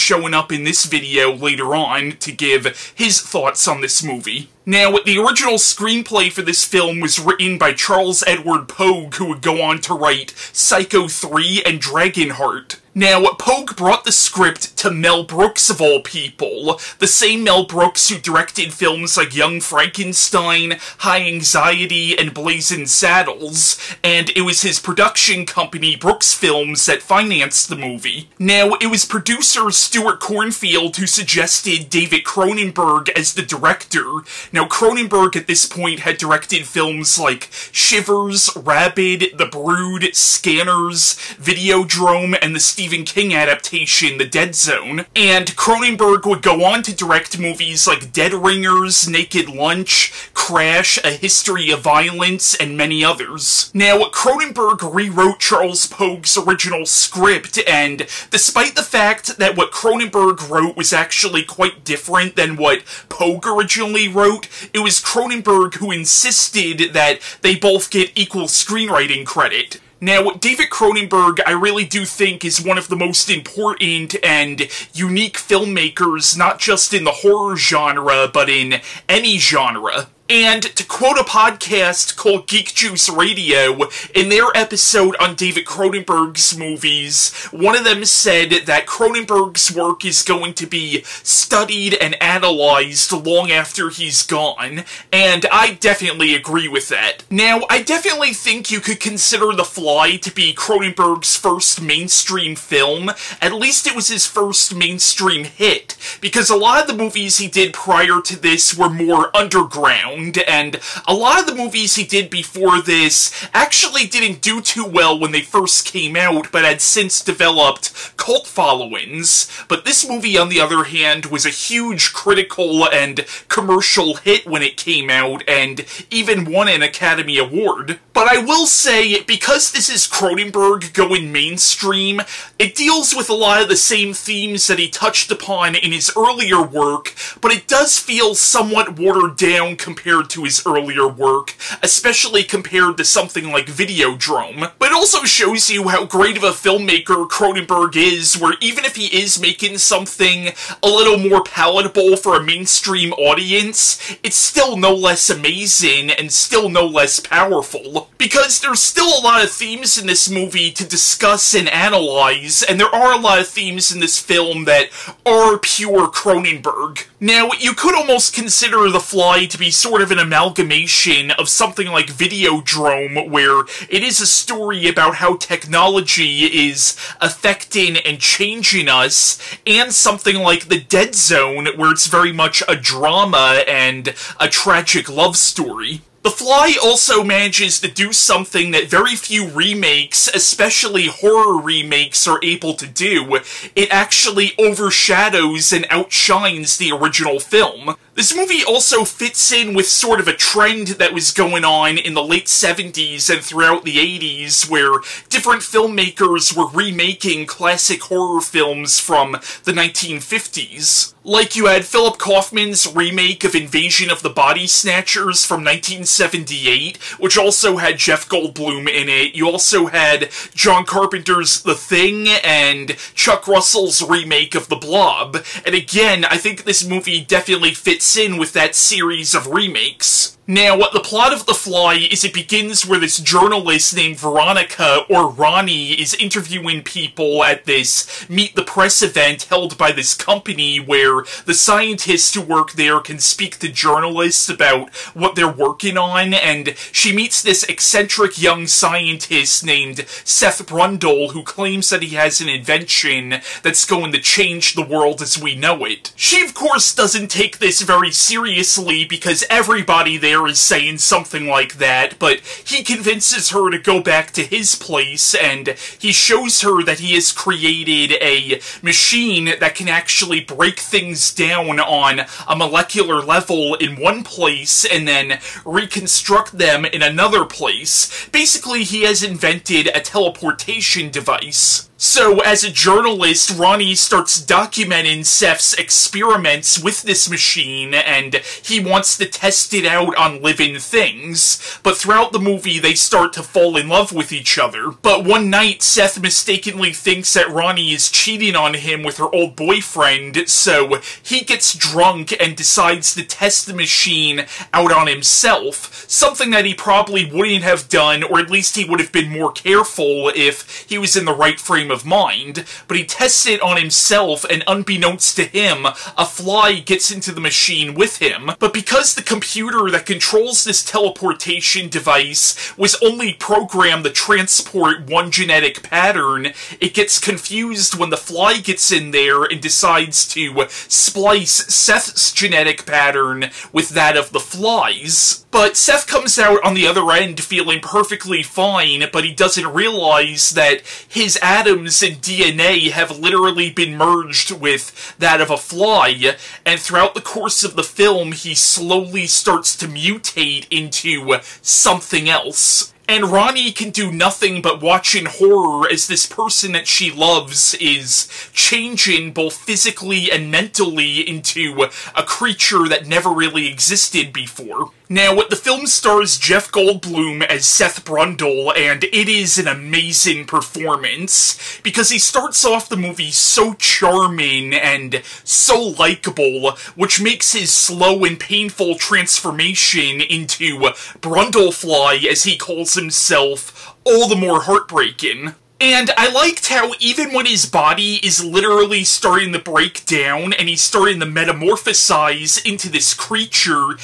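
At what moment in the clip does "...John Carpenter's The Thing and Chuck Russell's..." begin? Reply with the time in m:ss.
3:40.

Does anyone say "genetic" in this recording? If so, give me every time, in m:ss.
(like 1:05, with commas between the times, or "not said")
5:25, 5:32.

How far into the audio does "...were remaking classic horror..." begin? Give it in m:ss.
3:26.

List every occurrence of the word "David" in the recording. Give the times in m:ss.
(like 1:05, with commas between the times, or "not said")
0:31, 1:10, 1:25.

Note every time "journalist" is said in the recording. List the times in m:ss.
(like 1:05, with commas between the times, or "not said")
3:53, 4:03, 4:42.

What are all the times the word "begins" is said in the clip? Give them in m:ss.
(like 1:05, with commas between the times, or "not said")
3:52.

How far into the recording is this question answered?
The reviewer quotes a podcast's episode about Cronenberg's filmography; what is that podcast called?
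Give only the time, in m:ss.
1:22.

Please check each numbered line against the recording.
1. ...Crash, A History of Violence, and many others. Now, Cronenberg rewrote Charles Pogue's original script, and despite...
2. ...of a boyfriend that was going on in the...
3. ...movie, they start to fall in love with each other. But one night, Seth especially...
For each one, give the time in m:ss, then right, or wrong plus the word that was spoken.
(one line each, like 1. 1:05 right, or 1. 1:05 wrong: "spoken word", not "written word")
1. 0:50 right
2. 3:20 wrong: "trend", not "boyfriend"
3. 4:52 wrong: "mistakenly", not "especially".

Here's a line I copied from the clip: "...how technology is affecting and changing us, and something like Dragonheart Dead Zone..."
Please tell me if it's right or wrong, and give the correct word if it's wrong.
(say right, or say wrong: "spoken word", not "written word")
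wrong: "The", not "Dragonheart".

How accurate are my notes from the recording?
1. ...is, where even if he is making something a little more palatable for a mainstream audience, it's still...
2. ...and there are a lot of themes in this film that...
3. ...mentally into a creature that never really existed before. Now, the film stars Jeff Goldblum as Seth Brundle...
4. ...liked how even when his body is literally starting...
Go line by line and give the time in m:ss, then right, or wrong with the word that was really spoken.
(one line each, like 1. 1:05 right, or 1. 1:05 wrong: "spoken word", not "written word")
1. 2:27 right
2. 2:42 right
3. 6:00 right
4. 6:26 right.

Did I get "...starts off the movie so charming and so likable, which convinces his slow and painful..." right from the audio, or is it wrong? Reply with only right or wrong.
wrong.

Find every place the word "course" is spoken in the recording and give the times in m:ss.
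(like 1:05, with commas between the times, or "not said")
4:16, 5:47.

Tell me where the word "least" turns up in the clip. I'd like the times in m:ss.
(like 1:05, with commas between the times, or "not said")
1:43, 5:08.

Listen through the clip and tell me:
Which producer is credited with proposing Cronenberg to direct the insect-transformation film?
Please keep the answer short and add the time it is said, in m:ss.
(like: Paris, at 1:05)
Stuart Cornfeld, at 0:29.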